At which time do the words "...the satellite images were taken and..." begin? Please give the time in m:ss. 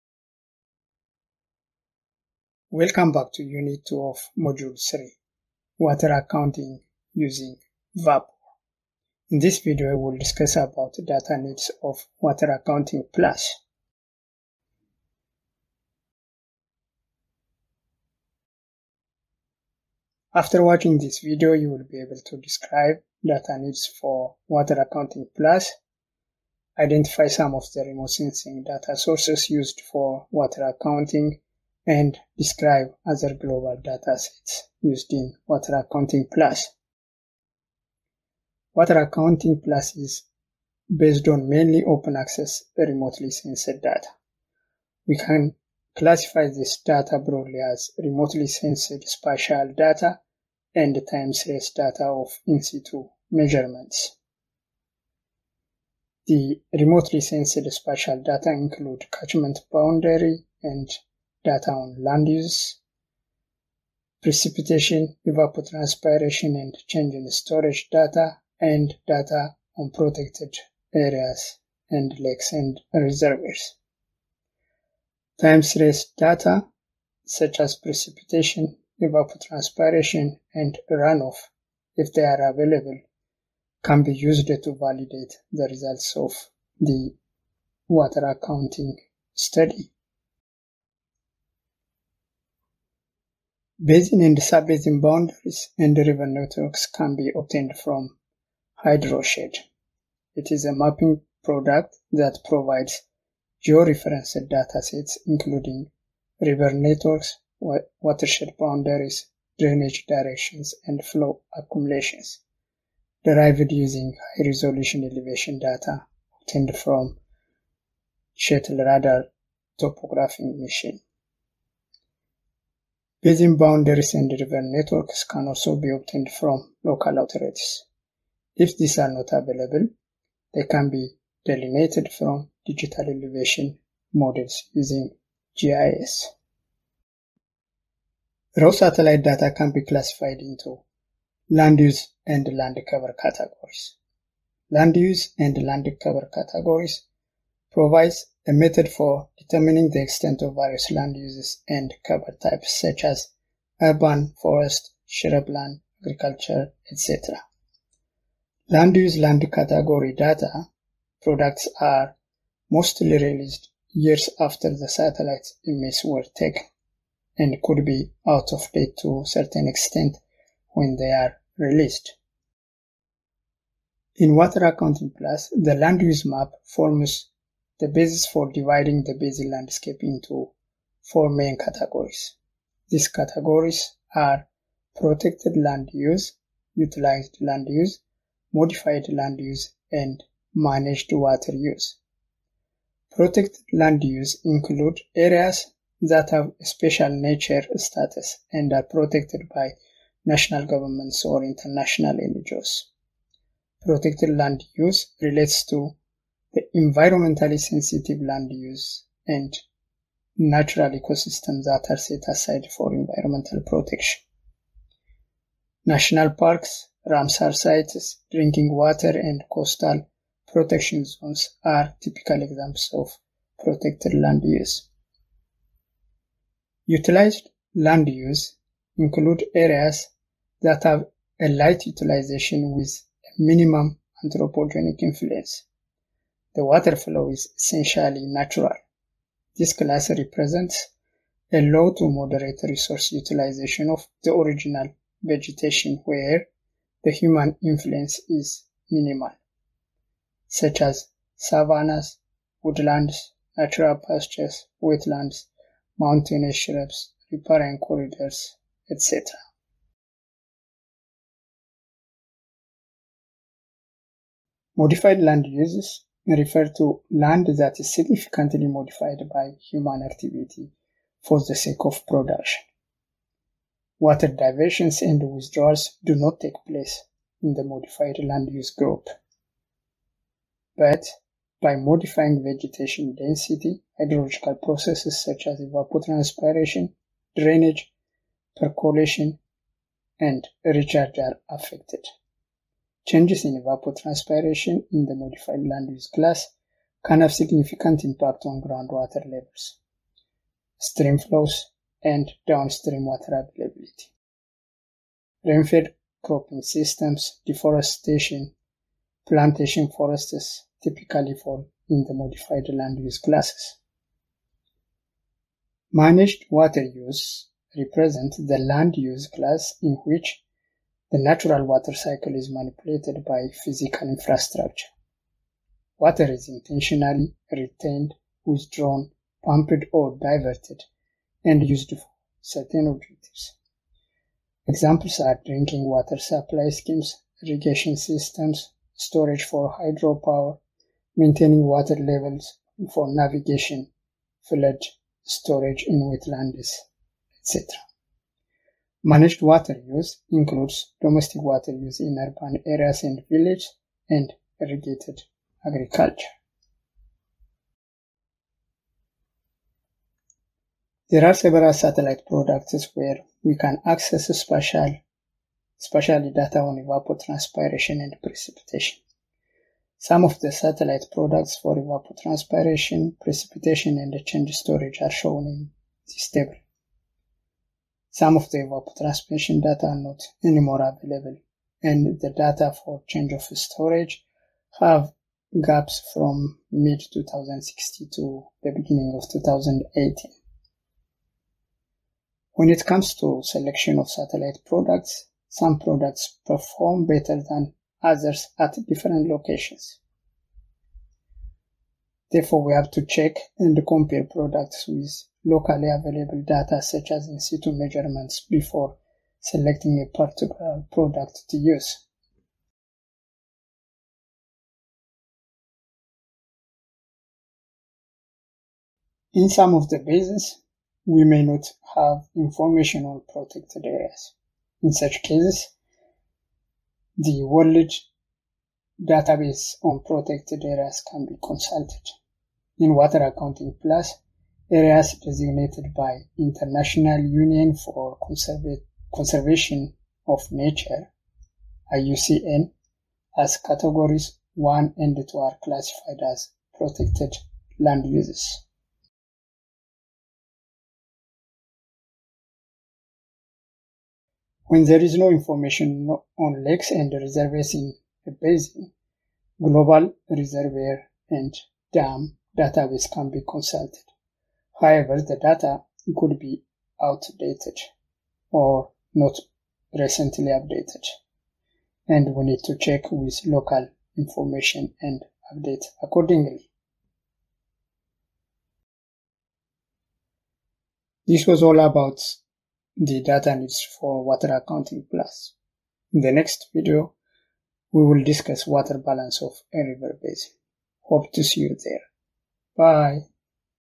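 2:44.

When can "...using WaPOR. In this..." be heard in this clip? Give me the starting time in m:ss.
0:07.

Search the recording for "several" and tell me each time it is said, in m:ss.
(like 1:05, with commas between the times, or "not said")
6:01.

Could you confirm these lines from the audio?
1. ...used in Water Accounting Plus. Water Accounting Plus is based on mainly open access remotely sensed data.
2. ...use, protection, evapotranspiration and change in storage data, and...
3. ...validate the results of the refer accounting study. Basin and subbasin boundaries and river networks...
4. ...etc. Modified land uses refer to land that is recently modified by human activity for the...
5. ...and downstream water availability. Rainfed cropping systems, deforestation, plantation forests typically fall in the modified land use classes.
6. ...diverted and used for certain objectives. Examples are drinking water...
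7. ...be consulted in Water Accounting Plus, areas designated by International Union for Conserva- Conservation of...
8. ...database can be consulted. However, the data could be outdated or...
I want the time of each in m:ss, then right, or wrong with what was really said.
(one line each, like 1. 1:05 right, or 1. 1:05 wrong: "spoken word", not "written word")
1. 0:34 right
2. 1:02 wrong: "precipitation", not "protection"
3. 1:24 wrong: "water", not "refer"
4. 4:18 wrong: "significantly", not "recently"
5. 5:02 right
6. 5:30 right
7. 7:11 right
8. 7:42 right.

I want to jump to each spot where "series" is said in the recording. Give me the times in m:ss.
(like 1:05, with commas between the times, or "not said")
0:51, 1:15.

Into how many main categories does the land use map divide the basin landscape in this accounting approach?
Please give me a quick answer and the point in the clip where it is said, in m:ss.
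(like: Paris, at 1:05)
4, at 3:01.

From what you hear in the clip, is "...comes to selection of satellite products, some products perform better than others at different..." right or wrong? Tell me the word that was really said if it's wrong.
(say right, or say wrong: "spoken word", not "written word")
right.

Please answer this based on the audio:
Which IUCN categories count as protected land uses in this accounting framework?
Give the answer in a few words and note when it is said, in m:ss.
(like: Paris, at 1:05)
Categories 1 and 2, at 7:23.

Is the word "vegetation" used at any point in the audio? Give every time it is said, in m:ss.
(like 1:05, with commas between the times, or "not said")
4:05, 4:42.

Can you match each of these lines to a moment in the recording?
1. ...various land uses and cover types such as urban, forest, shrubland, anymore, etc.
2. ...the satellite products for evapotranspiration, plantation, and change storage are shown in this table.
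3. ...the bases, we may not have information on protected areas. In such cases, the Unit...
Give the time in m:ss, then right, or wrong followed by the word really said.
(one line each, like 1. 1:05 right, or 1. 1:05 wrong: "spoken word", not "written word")
1. 2:30 wrong: "agriculture", not "anymore"
2. 6:10 wrong: "precipitation", not "plantation"
3. 6:59 wrong: "World", not "Unit".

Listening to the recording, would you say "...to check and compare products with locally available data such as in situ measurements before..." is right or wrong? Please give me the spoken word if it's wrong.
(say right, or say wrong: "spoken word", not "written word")
right.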